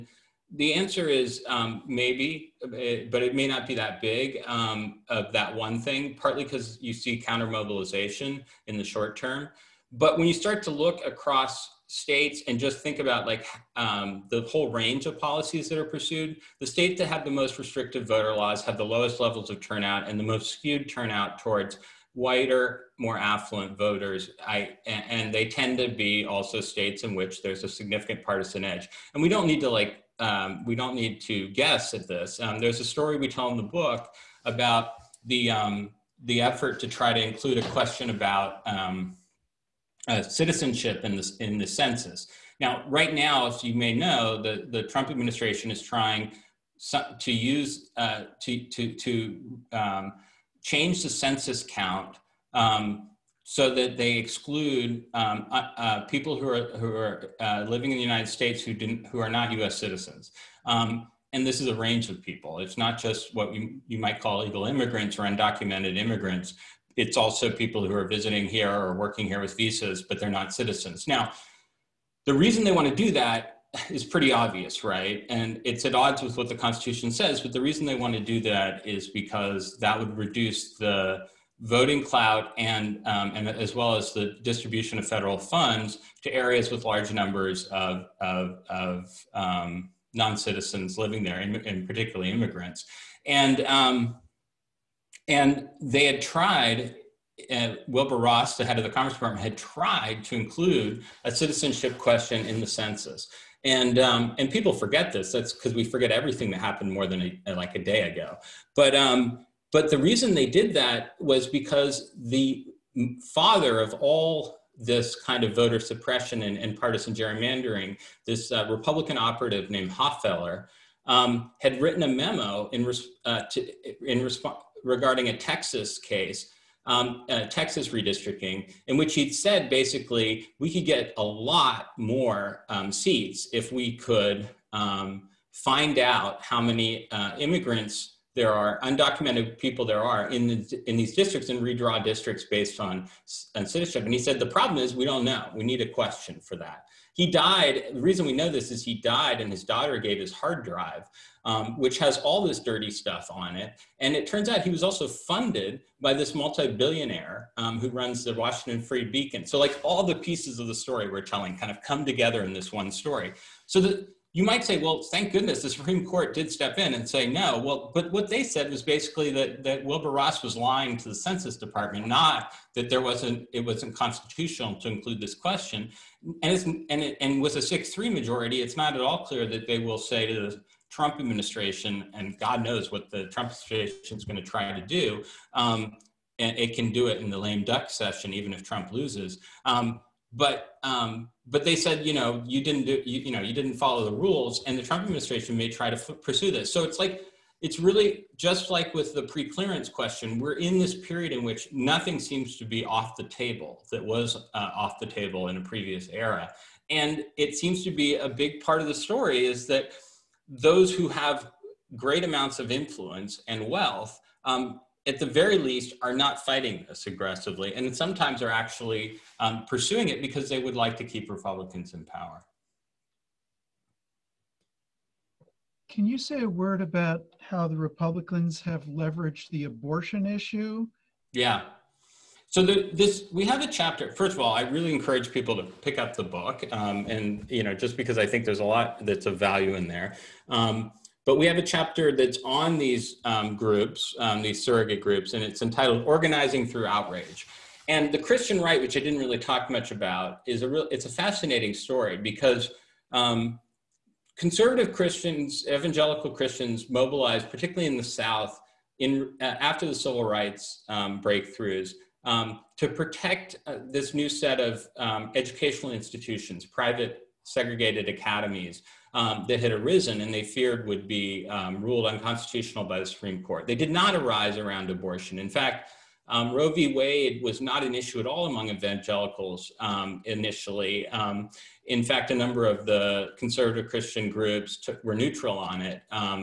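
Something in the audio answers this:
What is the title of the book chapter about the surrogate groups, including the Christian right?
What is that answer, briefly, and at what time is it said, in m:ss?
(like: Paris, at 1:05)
Organizing Through Outrage, at 4:06.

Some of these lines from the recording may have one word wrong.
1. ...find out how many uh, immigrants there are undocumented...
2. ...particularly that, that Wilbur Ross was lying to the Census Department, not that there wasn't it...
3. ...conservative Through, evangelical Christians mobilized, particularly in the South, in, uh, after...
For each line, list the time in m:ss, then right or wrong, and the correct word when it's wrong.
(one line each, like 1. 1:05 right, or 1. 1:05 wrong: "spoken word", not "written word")
1. 2:15 right
2. 2:48 wrong: "basically", not "particularly"
3. 4:14 wrong: "Christians", not "Through".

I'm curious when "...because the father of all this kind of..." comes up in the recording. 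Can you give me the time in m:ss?
1:51.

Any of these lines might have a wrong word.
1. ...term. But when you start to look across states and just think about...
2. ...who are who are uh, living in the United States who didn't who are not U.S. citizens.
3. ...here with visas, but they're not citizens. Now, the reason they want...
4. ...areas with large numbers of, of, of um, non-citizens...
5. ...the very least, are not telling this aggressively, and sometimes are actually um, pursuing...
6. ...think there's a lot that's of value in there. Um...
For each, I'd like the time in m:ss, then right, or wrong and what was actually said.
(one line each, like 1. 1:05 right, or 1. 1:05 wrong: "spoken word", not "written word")
1. 0:09 right
2. 0:56 right
3. 1:09 right
4. 1:26 right
5. 3:35 wrong: "fighting", not "telling"
6. 3:58 right.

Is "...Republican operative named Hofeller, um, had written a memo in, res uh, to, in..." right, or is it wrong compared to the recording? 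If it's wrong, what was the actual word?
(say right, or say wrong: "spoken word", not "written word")
right.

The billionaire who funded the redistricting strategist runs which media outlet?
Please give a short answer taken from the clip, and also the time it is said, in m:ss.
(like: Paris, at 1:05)
Washington Free Beacon, at 2:38.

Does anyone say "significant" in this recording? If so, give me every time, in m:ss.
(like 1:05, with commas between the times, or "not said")
0:27.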